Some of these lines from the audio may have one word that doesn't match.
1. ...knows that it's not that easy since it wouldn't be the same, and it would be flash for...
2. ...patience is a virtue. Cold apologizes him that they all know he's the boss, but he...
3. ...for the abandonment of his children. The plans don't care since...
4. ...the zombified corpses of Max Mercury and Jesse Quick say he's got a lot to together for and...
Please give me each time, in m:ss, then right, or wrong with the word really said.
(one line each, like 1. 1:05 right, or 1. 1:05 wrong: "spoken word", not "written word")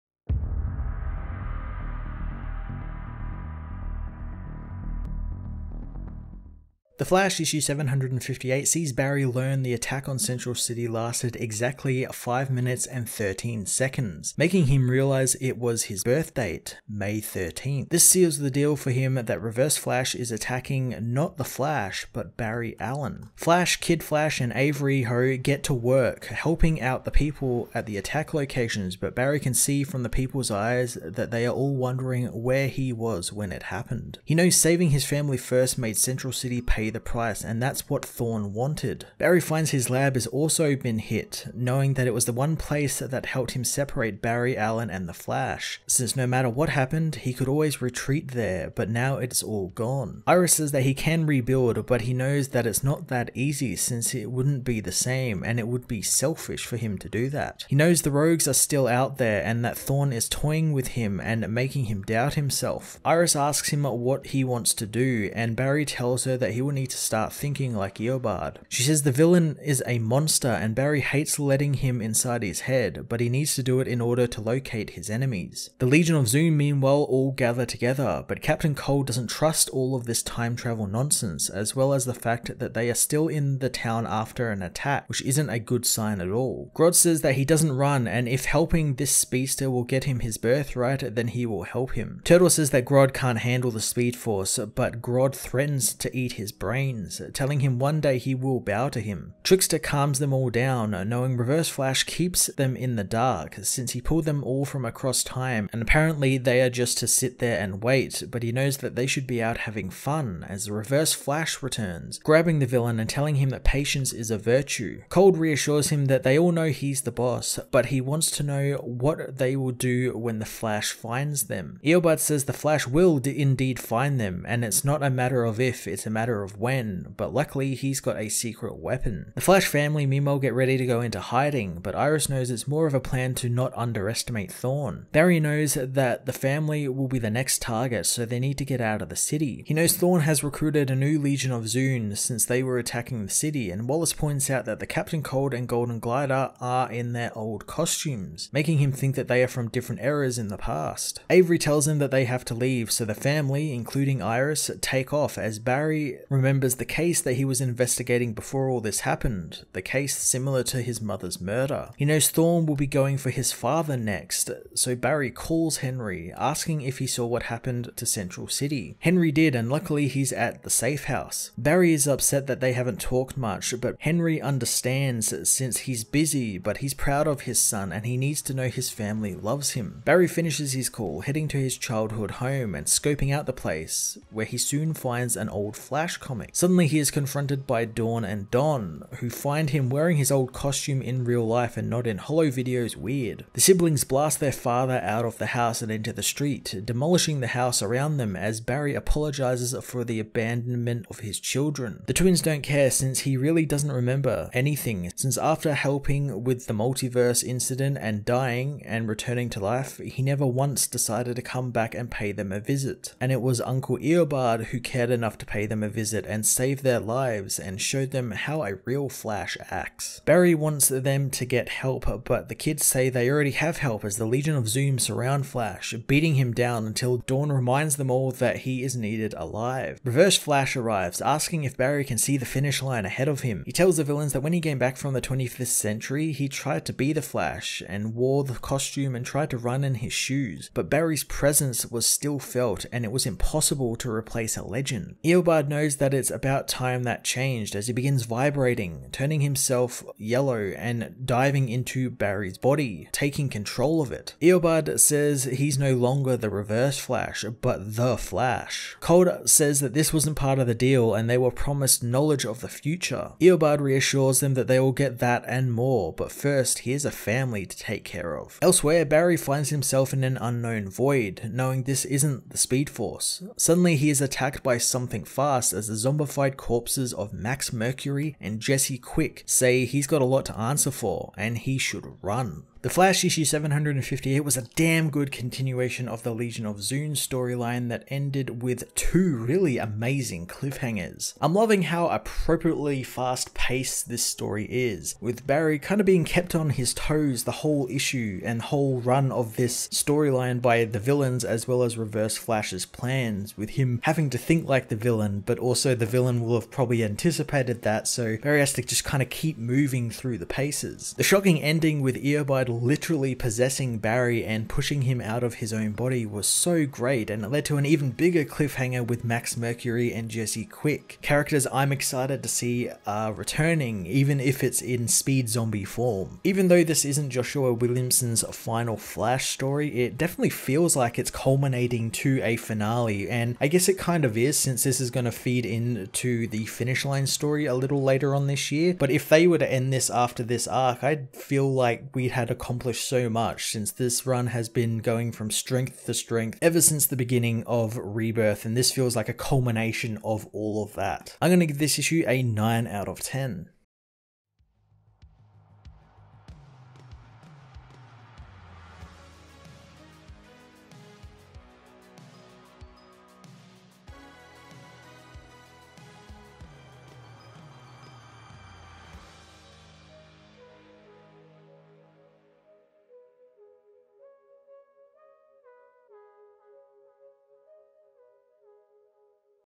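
1. 0:52 wrong: "selfish", not "flash"
2. 1:53 wrong: "reassures", not "apologizes"
3. 3:19 wrong: "twins", not "plans"
4. 4:35 wrong: "answer", not "together".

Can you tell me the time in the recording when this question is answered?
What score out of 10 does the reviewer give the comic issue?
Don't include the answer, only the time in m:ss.
5:52.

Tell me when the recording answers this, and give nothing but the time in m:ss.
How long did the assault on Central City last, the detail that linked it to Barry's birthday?
0:12.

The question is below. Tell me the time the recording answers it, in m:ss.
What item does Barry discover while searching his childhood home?
3:05.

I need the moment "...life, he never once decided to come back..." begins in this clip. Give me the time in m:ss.
3:29.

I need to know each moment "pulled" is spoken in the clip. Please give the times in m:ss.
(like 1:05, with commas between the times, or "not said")
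1:43.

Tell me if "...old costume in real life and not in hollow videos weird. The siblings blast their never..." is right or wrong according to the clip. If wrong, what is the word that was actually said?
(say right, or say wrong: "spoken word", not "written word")
wrong: "father", not "never".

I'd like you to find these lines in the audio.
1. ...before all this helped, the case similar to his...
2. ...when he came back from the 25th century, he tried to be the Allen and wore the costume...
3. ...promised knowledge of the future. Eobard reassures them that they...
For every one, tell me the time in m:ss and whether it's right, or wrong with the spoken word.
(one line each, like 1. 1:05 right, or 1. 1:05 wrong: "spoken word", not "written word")
1. 2:38 wrong: "happened", not "helped"
2. 3:54 wrong: "Flash", not "Allen"
3. 4:21 right.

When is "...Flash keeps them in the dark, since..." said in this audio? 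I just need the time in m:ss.
1:41.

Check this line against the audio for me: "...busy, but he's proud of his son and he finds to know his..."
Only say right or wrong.
wrong.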